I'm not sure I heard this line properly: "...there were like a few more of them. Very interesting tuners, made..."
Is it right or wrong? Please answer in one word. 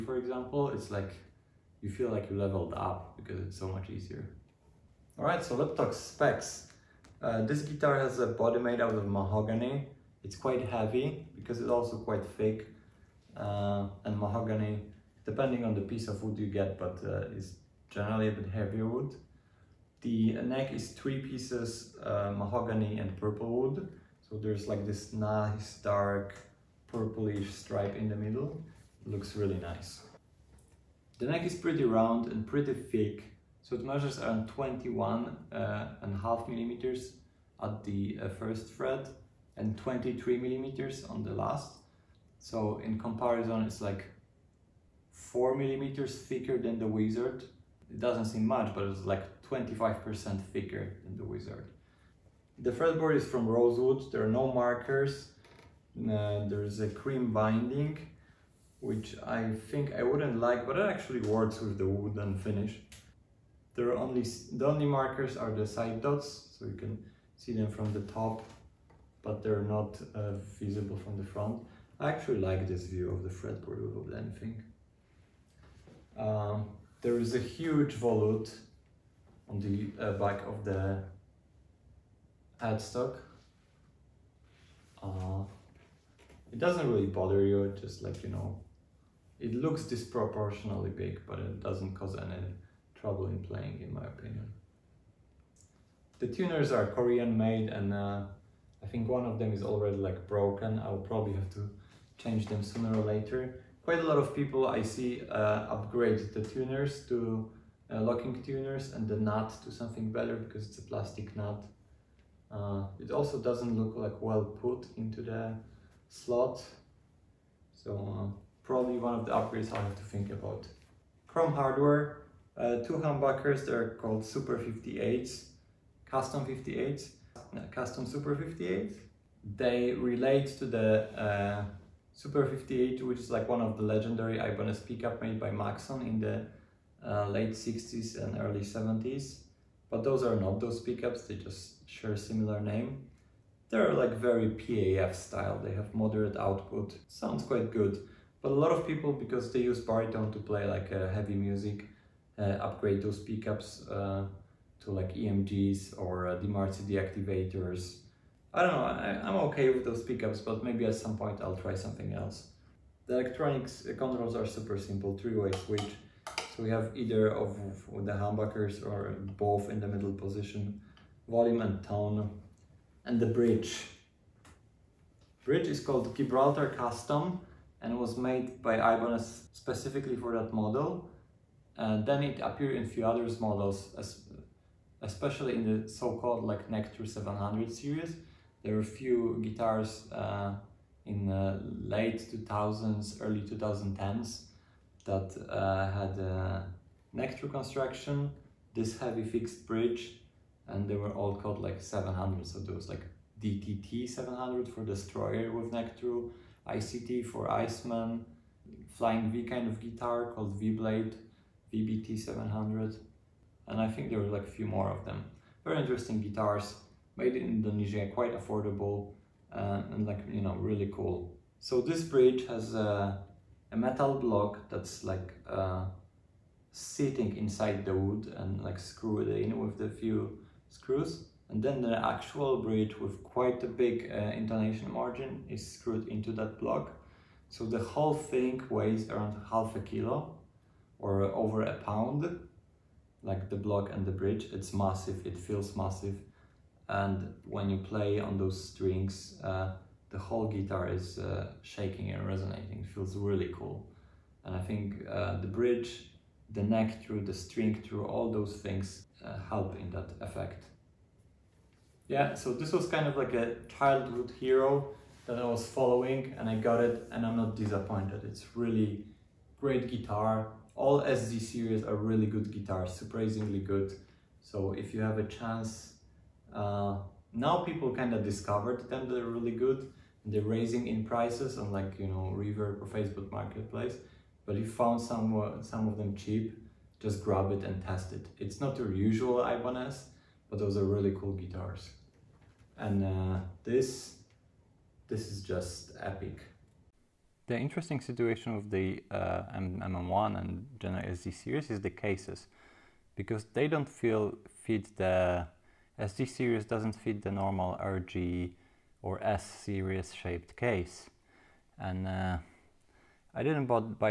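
wrong.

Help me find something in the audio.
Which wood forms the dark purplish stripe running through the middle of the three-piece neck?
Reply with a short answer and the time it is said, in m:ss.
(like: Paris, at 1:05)
Purple wood, at 0:23.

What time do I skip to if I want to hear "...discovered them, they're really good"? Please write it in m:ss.
4:38.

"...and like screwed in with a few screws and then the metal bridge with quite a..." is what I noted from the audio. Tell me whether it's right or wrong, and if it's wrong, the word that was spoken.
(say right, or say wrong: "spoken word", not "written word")
wrong: "actual", not "metal".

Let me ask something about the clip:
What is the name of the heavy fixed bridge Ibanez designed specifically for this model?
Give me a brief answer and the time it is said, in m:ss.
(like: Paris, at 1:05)
Gibraltar Custom, at 2:56.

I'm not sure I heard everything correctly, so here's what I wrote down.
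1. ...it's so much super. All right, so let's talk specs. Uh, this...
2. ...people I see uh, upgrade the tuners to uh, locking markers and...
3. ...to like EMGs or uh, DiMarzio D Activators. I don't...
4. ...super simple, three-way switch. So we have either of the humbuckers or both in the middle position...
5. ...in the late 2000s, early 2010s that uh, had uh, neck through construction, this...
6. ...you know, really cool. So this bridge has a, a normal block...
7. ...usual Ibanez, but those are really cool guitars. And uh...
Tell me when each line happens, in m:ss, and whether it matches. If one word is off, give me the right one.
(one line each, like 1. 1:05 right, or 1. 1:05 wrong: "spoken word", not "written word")
1. 0:03 wrong: "easier", not "super"
2. 1:44 wrong: "tuners", not "markers"
3. 2:34 right
4. 2:44 right
5. 3:11 right
6. 3:40 wrong: "metal", not "normal"
7. 4:48 right.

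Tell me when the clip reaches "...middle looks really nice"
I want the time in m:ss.
0:28.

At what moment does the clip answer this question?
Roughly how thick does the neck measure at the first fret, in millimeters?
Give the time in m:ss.
0:34.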